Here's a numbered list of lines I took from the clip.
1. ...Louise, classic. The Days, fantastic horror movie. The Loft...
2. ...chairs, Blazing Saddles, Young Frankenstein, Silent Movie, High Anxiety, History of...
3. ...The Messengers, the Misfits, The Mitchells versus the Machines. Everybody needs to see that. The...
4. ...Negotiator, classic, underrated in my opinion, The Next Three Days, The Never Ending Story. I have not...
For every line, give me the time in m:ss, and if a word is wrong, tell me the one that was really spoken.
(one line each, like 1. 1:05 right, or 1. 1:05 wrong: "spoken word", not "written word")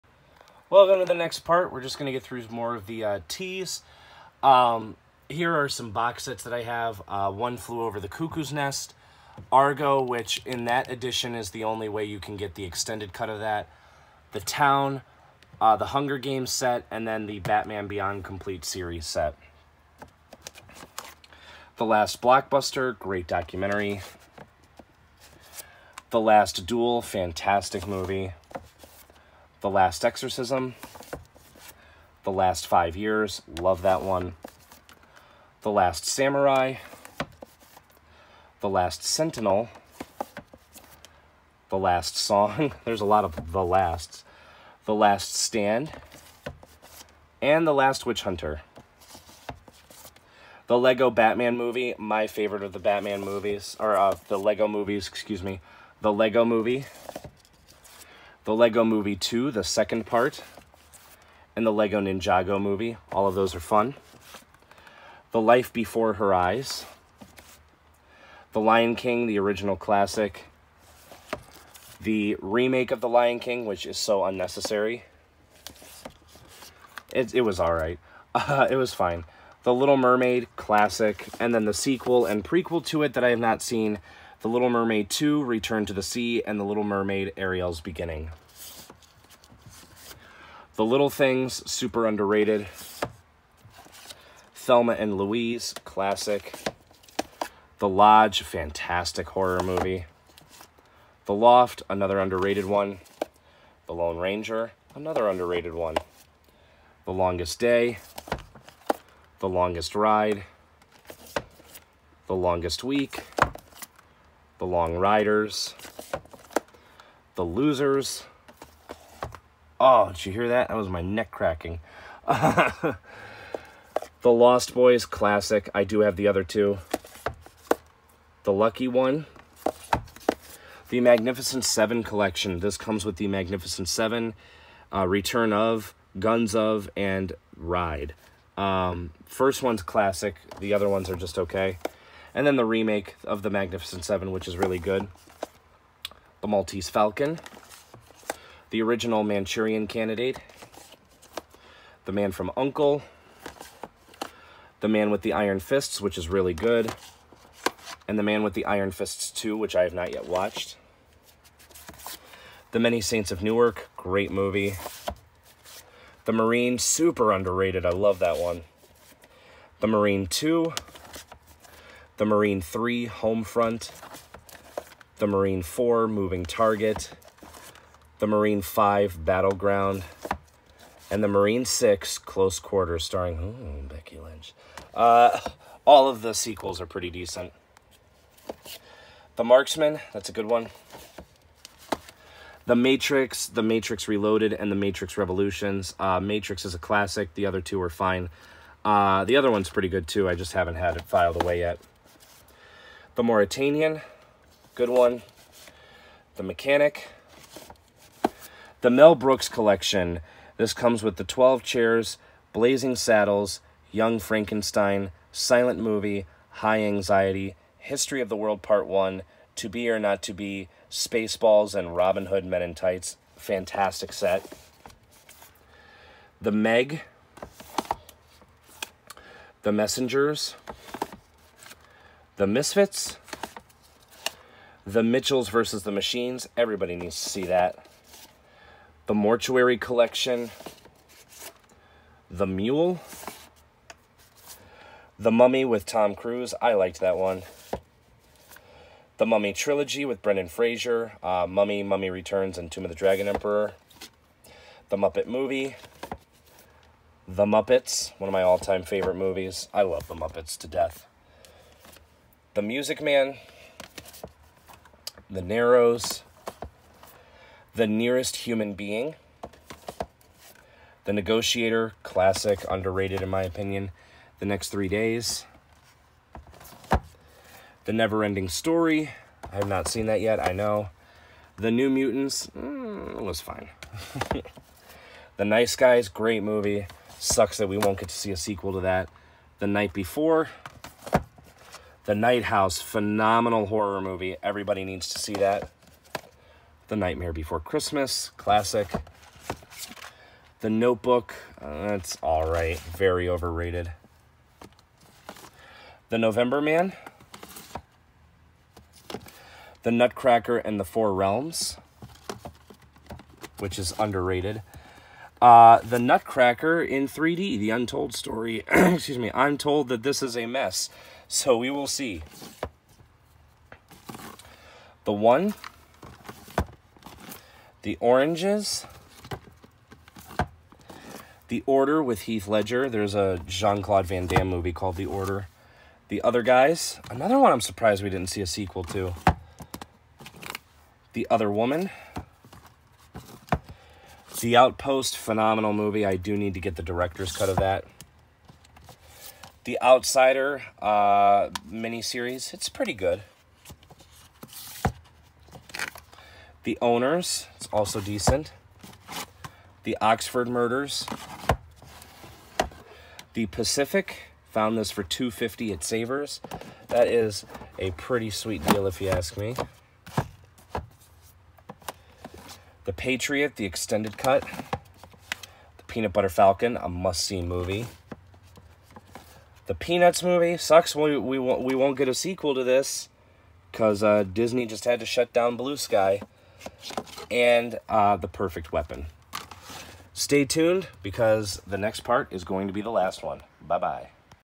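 1. 1:35 wrong: "Lodge", not "Days"
2. 3:31 right
3. 3:49 right
4. 4:31 right.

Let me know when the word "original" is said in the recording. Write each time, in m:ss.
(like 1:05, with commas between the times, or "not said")
1:09, 2:28.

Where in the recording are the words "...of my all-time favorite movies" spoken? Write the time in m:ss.
4:18.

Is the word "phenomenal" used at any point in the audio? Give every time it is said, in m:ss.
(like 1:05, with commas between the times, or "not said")
4:52, 5:45.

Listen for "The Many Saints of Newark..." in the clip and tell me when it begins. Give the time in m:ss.
2:42.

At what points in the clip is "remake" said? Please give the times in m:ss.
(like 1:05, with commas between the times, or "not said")
1:12, 2:22.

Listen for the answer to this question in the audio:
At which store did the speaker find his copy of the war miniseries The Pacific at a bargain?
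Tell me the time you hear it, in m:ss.
6:05.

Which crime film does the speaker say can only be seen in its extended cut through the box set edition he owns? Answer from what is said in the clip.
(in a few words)
Argo.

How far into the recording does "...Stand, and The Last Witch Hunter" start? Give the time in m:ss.
0:45.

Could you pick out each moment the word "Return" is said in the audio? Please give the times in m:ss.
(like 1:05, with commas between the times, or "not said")
1:25, 2:15, 4:12.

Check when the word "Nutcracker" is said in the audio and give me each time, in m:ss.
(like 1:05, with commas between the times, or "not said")
5:09, 5:15.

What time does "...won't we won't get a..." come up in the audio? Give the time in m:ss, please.
6:21.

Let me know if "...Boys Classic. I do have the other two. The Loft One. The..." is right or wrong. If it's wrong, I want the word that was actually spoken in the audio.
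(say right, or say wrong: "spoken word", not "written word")
wrong: "Lucky", not "Loft".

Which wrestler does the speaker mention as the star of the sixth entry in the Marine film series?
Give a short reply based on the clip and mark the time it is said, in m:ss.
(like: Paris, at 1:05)
Becky Lynch, at 3:03.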